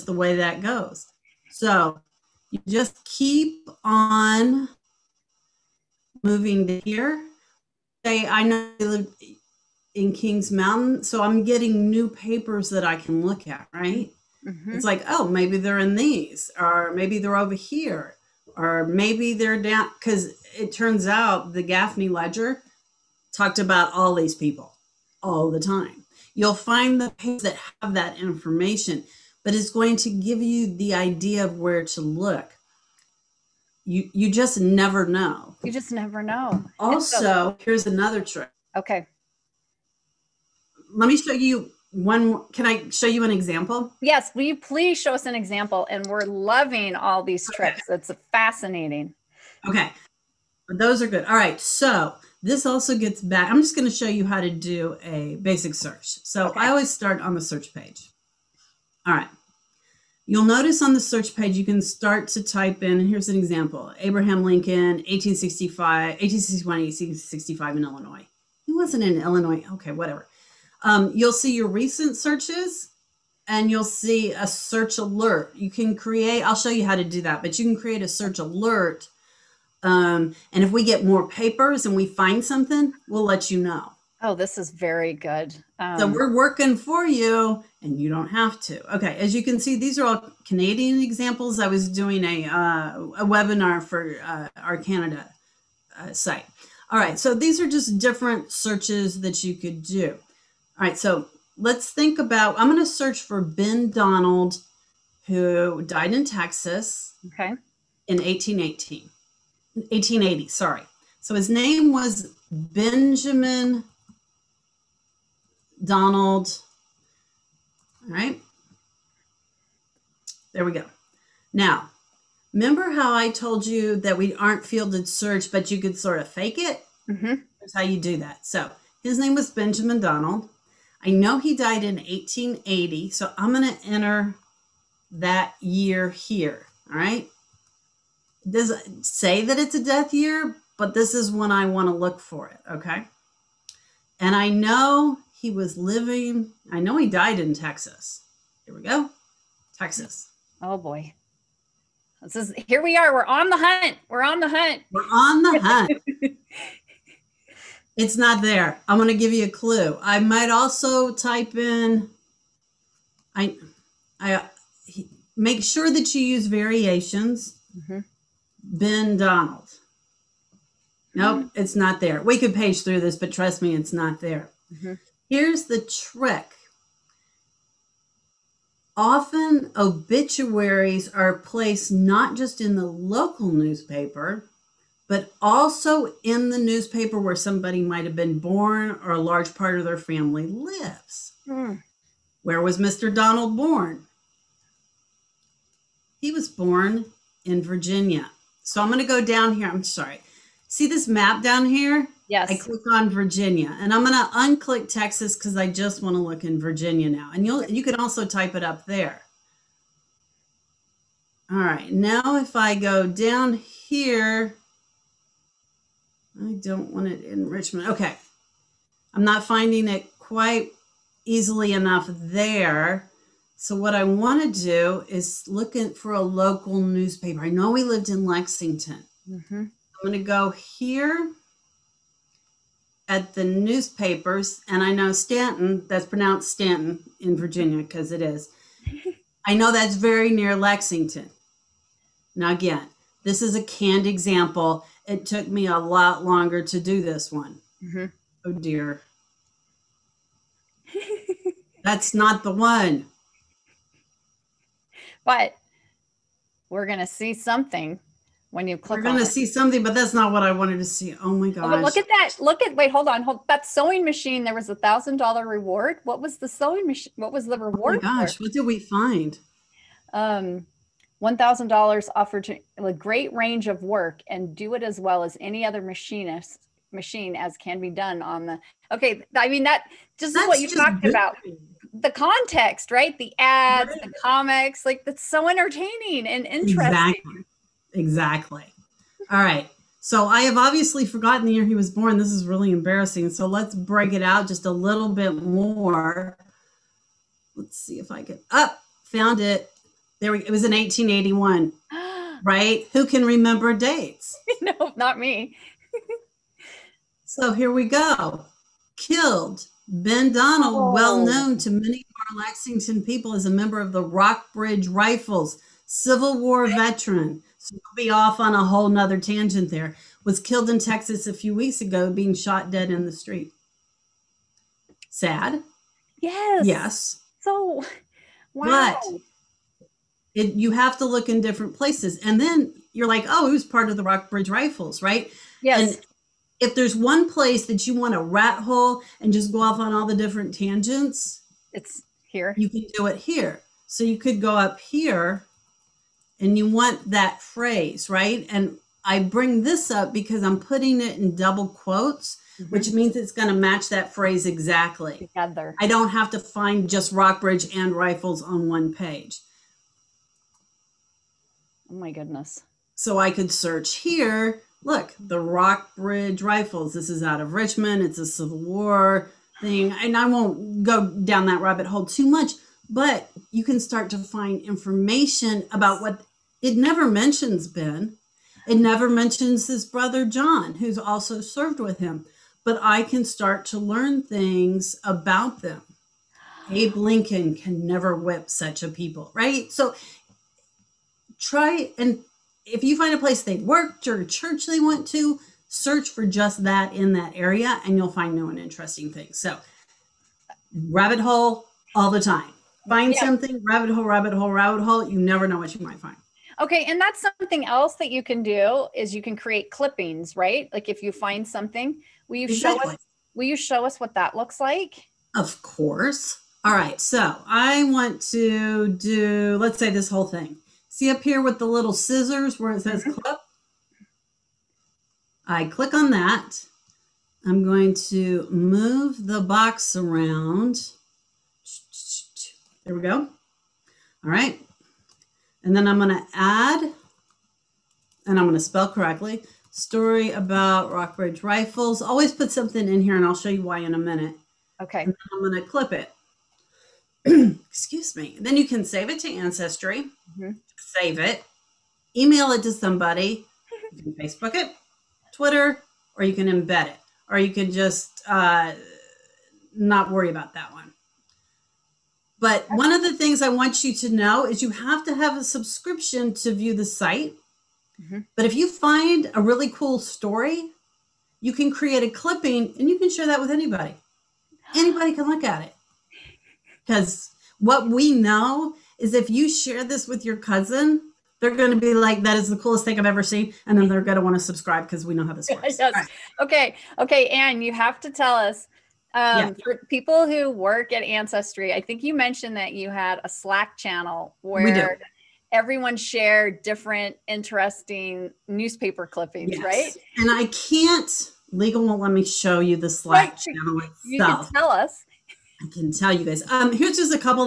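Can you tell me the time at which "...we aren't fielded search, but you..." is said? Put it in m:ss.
2:04.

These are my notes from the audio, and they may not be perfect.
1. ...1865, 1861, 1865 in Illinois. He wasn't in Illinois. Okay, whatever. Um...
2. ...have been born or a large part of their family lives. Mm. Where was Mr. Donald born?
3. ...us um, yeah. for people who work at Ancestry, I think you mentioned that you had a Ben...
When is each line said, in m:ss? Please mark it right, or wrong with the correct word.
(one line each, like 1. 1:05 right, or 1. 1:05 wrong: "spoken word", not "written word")
1. 1:05 right
2. 3:08 right
3. 8:08 wrong: "Slack", not "Ben".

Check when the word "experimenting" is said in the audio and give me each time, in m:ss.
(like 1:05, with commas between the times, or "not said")
not said.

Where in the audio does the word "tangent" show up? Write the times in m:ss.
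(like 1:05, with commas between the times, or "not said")
5:19, 5:40.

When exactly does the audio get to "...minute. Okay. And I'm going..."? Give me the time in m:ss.
7:23.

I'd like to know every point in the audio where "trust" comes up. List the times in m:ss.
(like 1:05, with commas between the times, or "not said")
2:53.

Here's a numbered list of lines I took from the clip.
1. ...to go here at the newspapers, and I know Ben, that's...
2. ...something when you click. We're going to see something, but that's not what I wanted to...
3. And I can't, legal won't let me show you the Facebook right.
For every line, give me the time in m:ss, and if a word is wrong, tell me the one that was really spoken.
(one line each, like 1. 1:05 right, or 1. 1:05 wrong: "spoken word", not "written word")
1. 3:50 wrong: "Staunton", not "Ben"
2. 4:17 right
3. 8:20 wrong: "Slack", not "Facebook".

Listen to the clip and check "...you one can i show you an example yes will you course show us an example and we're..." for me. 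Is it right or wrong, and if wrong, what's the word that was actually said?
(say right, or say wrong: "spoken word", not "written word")
wrong: "please", not "course".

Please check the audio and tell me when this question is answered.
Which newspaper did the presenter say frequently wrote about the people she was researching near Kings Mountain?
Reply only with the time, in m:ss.
0:21.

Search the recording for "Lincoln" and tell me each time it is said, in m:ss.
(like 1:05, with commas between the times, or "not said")
1:04, 6:26.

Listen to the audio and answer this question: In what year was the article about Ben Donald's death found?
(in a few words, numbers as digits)
1881.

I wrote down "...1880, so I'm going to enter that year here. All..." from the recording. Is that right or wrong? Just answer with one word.
right.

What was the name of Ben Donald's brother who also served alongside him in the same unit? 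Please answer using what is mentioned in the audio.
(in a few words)
John.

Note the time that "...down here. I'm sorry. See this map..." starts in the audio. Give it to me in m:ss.
3:19.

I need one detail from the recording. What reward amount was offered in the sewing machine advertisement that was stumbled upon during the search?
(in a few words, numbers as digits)
$1000.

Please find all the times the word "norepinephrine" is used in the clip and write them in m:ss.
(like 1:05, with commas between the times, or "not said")
not said.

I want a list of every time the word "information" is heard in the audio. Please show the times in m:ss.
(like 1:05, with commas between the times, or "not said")
0:28, 6:14.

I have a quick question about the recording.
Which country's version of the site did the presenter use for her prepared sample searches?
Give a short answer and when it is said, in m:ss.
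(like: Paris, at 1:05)
Canada, at 1:34.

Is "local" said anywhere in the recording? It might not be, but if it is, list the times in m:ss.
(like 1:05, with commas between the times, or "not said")
3:02, 3:46.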